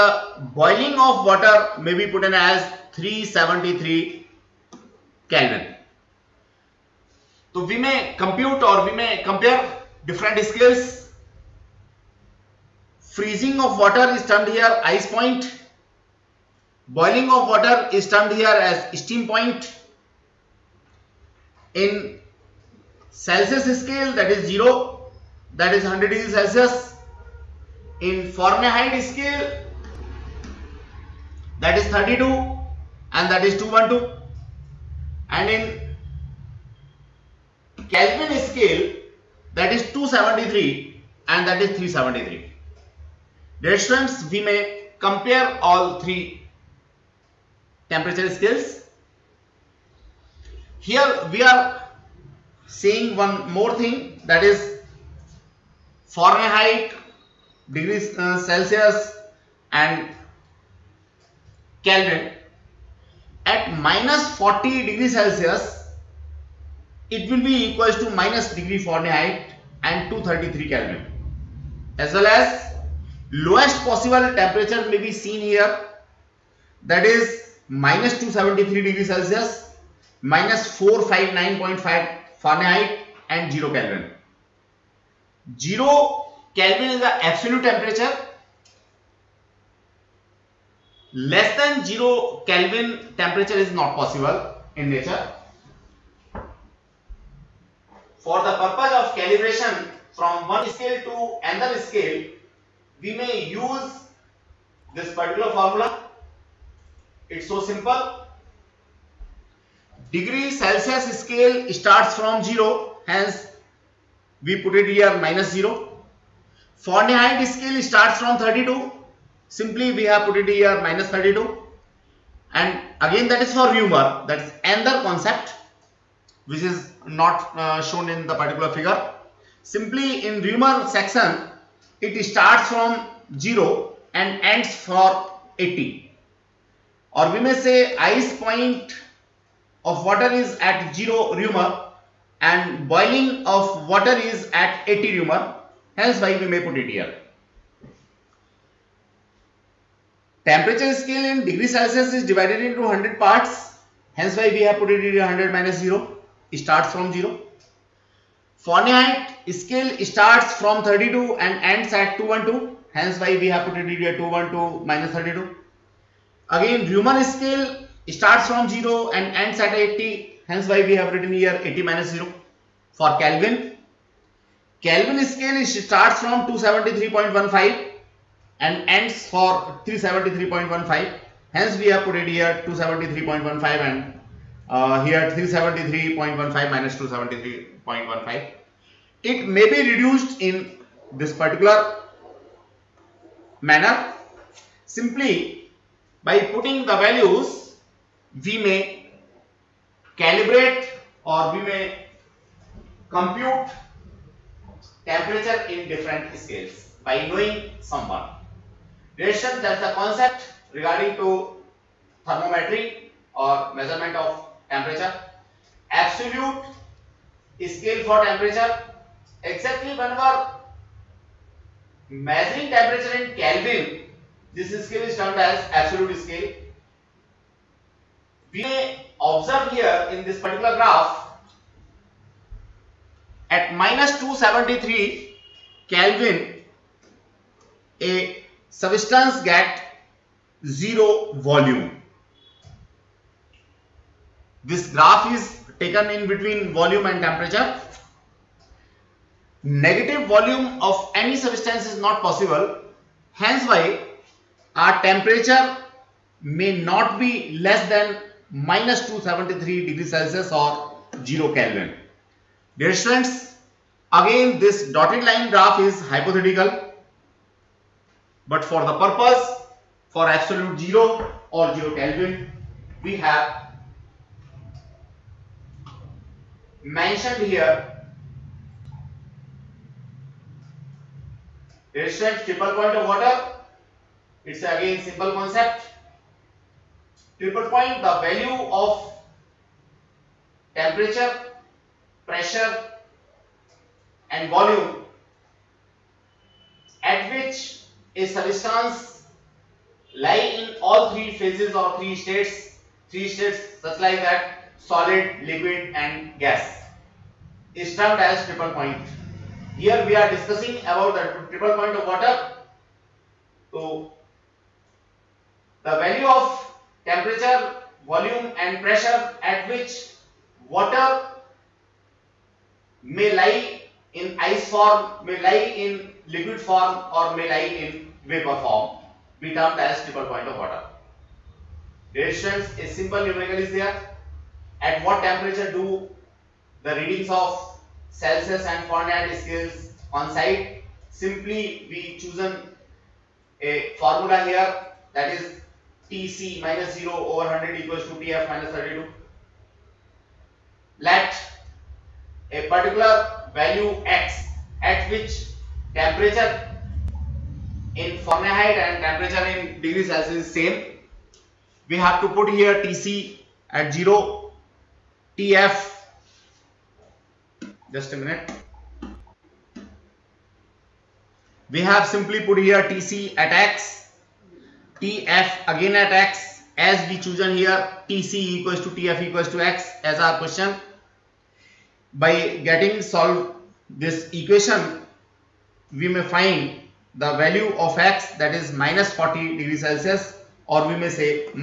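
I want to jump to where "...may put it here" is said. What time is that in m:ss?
2:26.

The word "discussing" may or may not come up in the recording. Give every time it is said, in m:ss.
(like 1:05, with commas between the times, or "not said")
5:10.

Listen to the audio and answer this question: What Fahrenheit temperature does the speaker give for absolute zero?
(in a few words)
-459.5.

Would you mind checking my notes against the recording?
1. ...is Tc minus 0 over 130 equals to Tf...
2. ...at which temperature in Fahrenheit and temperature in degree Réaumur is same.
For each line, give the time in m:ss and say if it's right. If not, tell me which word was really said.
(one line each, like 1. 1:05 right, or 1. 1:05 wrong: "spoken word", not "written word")
1. 5:45 wrong: "100", not "130"
2. 5:54 wrong: "Celsius", not "Réaumur".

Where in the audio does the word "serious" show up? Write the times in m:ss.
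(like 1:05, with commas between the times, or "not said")
not said.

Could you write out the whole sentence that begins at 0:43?
Dear students, we may compare all three temperature scales.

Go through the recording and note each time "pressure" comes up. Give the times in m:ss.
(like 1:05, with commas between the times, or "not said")
4:52, 5:18.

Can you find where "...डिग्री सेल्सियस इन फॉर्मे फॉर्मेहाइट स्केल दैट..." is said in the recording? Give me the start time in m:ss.
0:26.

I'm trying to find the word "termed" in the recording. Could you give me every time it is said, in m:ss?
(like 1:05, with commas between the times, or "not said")
5:07, 5:29.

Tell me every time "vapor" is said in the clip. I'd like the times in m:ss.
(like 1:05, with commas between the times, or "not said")
5:28.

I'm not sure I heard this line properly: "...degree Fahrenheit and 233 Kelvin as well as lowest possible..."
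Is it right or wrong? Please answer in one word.
right.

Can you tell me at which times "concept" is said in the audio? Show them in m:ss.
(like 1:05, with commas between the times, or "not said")
2:05, 3:29, 4:45.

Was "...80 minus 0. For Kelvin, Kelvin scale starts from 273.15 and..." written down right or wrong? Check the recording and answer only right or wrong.
right.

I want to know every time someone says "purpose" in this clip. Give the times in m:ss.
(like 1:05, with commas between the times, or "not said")
1:38, 4:28.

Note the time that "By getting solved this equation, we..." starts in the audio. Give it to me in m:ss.
6:22.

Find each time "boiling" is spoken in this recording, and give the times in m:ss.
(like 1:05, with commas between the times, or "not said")
0:00, 2:22.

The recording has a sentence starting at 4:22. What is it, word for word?
Dear students, again this dotted line graph is hypothetical.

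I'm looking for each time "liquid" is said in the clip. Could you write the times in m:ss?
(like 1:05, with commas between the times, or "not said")
5:05, 5:26.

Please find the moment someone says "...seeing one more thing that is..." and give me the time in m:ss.
0:52.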